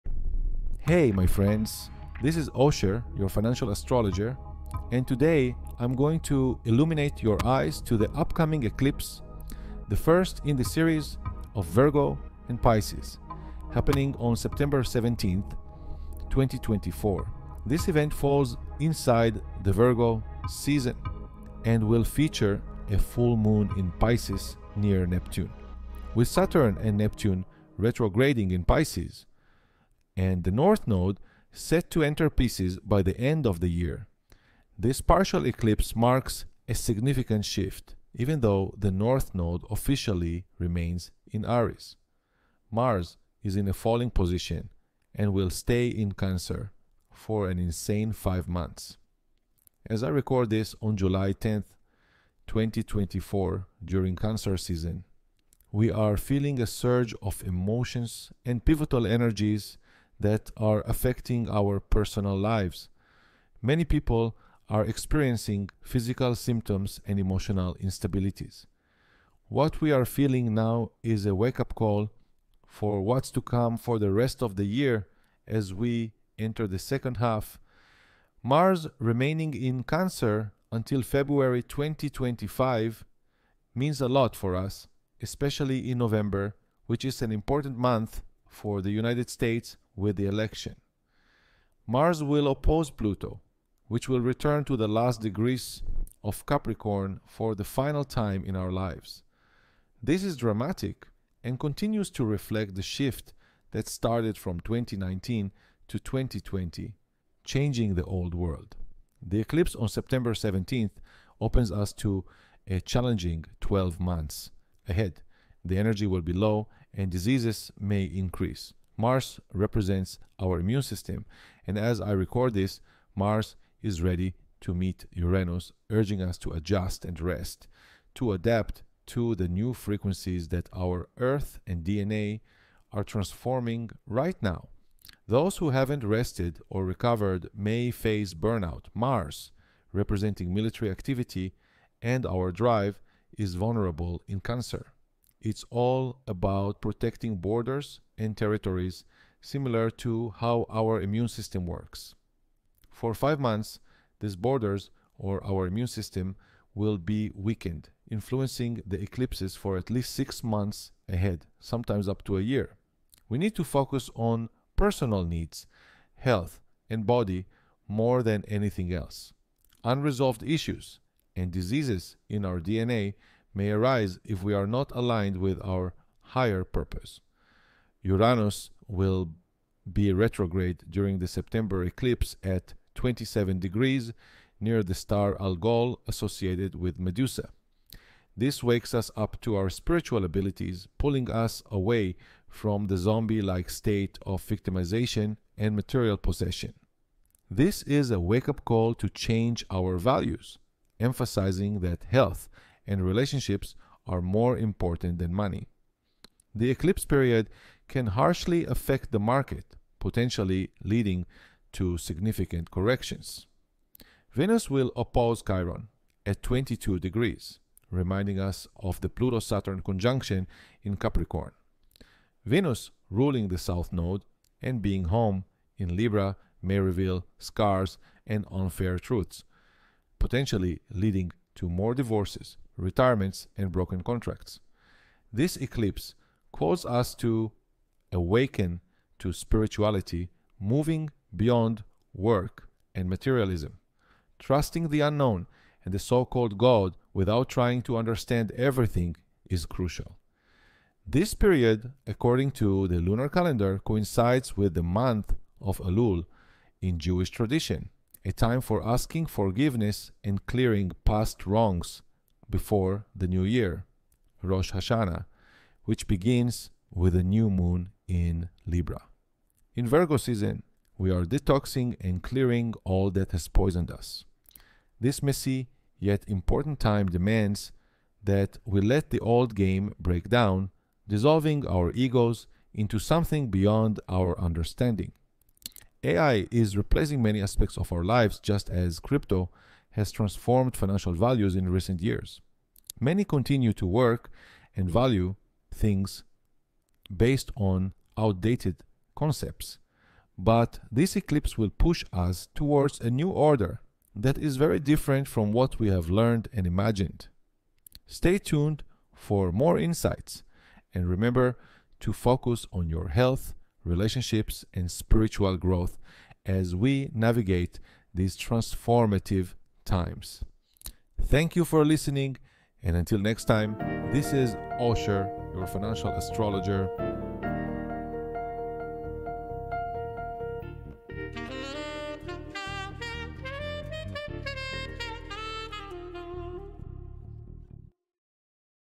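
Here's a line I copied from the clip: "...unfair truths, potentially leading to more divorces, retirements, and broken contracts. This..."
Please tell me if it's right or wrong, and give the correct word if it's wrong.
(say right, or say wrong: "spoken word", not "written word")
right.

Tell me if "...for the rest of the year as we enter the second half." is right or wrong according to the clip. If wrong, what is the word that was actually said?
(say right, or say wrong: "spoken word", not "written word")
right.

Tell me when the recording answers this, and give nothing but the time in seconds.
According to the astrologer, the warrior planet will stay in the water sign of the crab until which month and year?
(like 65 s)
81 s.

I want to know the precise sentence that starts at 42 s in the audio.
Mars is in a falling position and will stay in Cancer for an insane five months.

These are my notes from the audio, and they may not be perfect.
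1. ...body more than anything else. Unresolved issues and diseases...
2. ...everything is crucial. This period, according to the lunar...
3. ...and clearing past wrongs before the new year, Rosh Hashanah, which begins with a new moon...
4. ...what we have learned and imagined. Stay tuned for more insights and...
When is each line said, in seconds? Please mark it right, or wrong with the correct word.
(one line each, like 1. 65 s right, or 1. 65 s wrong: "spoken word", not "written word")
1. 167 s right
2. 248 s right
3. 260 s right
4. 305 s right.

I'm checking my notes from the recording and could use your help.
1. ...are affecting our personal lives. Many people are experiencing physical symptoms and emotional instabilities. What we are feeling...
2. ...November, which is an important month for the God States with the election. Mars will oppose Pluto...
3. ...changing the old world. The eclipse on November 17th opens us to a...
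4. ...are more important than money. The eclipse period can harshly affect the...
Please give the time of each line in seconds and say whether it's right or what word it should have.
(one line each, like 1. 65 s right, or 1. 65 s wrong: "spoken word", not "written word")
1. 60 s right
2. 85 s wrong: "United", not "God"
3. 107 s wrong: "September", not "November"
4. 204 s right.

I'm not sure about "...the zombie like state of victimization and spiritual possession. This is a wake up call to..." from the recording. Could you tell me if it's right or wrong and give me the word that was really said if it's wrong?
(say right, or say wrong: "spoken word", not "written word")
wrong: "material", not "spiritual".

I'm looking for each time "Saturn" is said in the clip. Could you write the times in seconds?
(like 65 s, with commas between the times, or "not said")
26 s, 219 s.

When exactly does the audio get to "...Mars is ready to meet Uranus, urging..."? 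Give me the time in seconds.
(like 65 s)
123 s.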